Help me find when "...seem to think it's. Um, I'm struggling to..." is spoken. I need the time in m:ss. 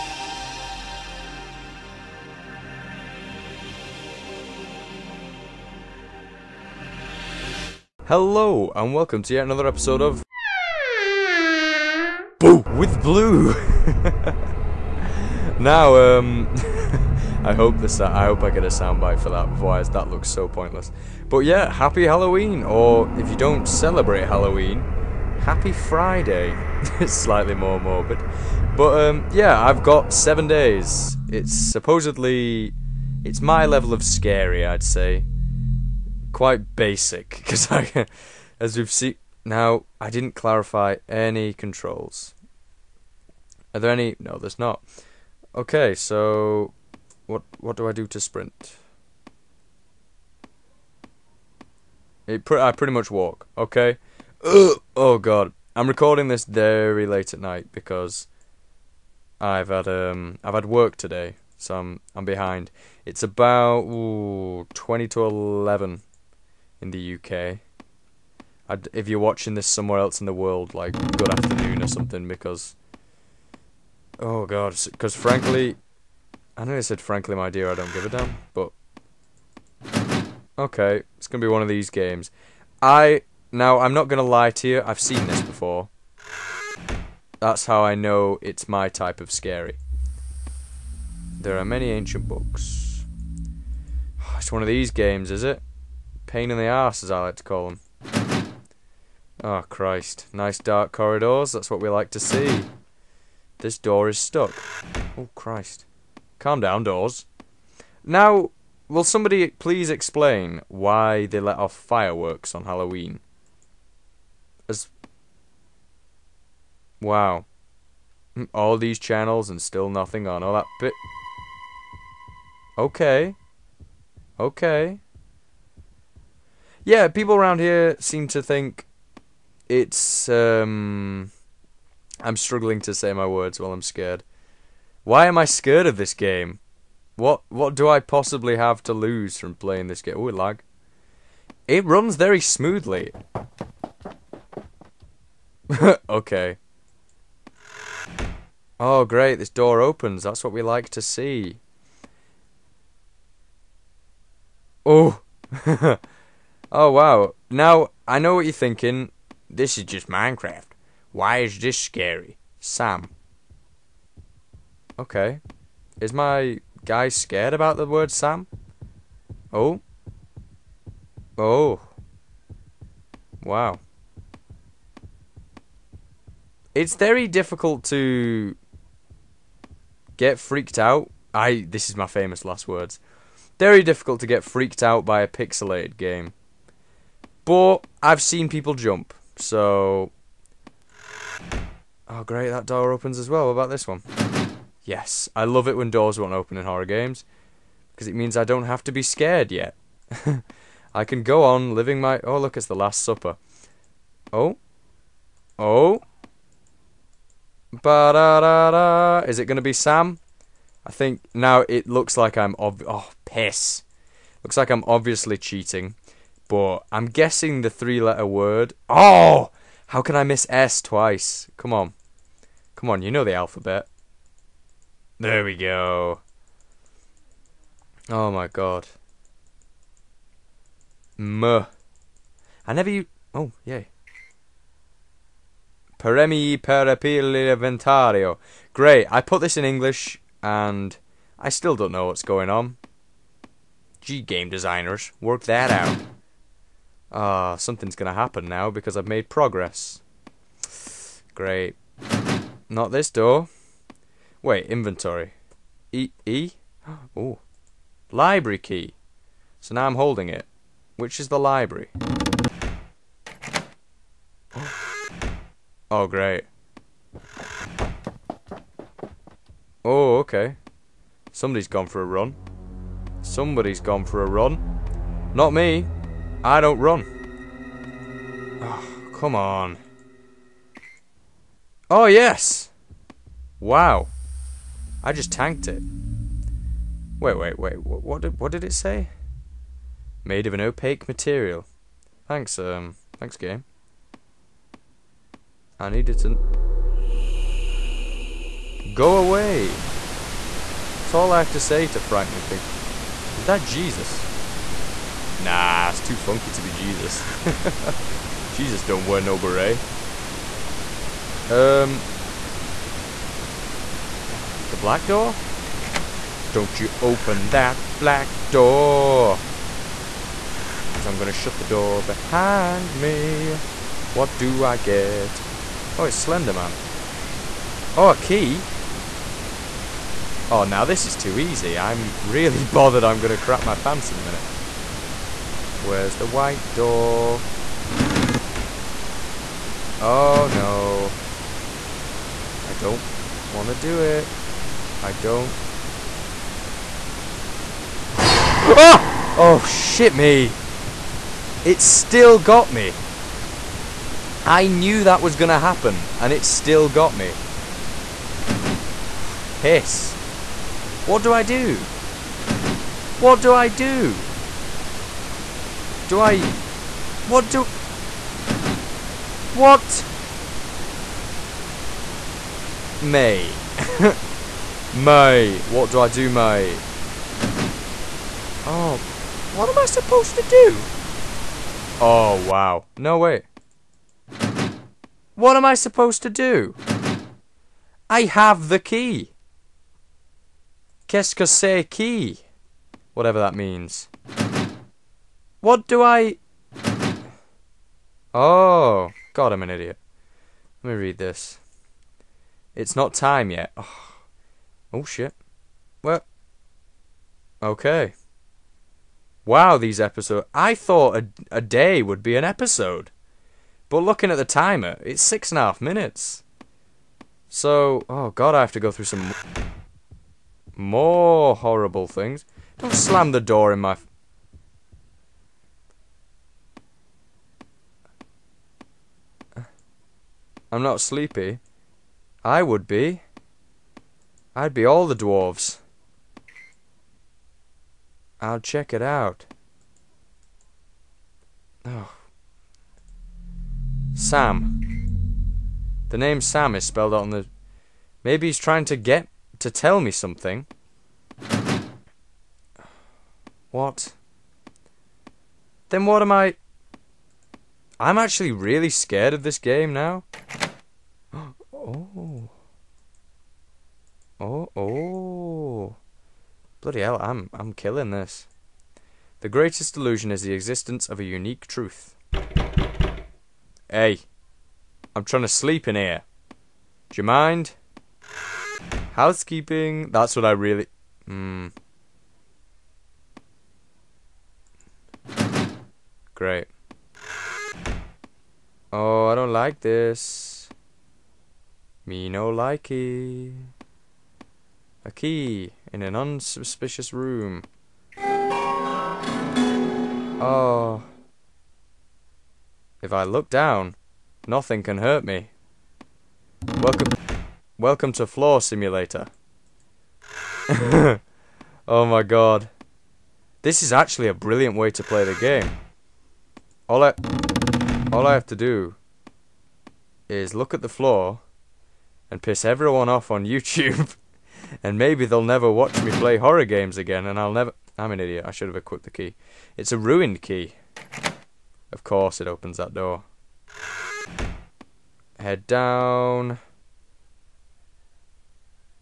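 2:07.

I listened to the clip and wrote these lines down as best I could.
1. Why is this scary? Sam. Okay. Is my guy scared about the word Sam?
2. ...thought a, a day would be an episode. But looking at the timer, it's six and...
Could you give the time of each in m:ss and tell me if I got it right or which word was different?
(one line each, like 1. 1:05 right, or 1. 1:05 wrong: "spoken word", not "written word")
1. 2:41 right
2. 6:50 right.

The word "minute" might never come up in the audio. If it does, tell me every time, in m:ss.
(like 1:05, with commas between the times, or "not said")
5:34, 6:55.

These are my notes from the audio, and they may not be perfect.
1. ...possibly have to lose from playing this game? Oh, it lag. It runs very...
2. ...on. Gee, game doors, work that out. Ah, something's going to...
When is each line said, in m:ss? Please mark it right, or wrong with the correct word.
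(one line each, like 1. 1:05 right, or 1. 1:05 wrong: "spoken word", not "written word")
1. 2:17 right
2. 4:02 wrong: "designers", not "doors".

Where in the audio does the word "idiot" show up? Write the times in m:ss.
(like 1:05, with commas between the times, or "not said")
6:39, 8:48.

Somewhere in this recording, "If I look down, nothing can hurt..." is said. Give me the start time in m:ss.
8:23.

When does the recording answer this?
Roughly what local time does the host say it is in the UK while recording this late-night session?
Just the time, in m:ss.
1:04.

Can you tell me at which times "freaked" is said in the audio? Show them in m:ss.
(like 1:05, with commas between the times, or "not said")
3:00, 3:04.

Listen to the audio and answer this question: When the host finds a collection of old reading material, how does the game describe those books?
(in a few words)
ancient books.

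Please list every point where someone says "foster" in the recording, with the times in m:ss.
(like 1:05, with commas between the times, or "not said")
not said.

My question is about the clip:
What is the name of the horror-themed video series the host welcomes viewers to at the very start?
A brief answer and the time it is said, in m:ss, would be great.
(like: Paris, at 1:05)
Boo with Blue, at 0:12.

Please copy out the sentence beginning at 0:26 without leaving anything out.
it's slightly more morbid, but um, yeah, I've got seven days.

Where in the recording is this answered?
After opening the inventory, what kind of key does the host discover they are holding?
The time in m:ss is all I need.
4:18.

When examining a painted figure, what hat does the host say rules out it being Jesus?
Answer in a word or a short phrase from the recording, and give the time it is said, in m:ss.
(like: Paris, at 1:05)
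beret, at 5:09.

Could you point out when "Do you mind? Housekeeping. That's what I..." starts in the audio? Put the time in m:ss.
7:57.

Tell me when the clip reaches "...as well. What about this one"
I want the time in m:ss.
3:13.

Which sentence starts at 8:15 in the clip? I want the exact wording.
A key in an unsuspicious room.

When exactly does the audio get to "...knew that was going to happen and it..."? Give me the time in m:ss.
5:54.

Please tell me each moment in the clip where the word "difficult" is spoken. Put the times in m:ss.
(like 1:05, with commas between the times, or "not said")
2:57, 3:03.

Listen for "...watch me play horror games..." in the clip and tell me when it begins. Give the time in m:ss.
8:45.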